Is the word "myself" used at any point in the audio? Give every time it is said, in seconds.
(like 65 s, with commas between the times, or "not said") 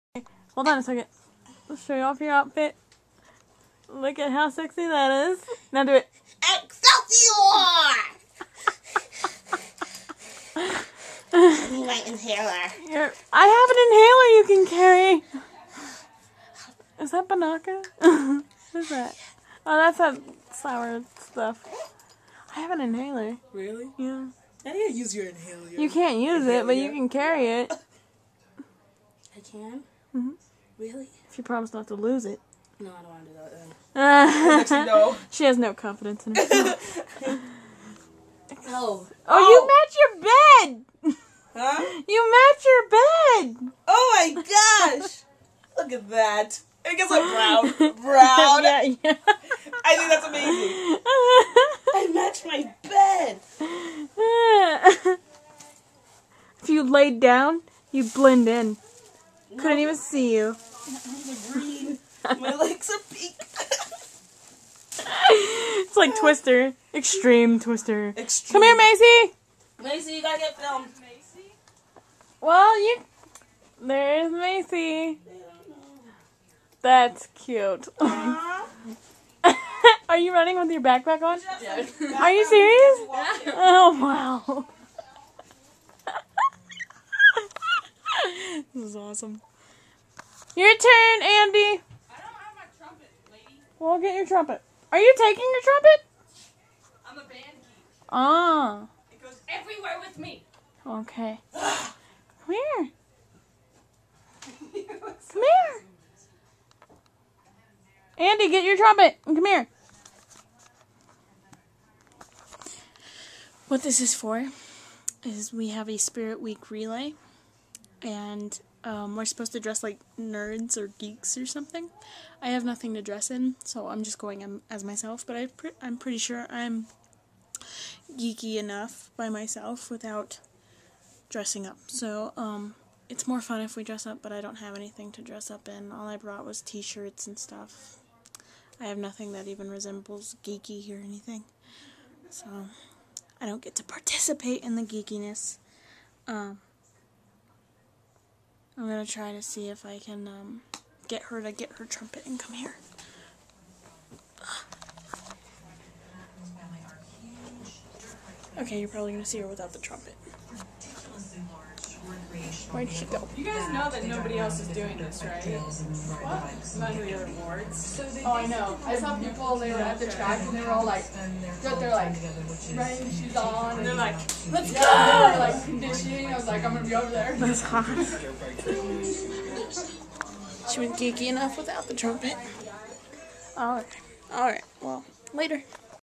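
124 s, 129 s.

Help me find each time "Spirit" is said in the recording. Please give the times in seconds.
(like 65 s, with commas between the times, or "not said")
115 s.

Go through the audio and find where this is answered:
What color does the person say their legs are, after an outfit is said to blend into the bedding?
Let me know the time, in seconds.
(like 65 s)
63 s.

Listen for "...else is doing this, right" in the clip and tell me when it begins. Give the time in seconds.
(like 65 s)
164 s.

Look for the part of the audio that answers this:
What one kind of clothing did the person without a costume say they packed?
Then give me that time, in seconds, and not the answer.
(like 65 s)
136 s.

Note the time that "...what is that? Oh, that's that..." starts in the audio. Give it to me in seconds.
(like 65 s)
18 s.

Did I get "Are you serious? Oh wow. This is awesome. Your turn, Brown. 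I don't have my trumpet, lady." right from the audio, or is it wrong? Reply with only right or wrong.
wrong.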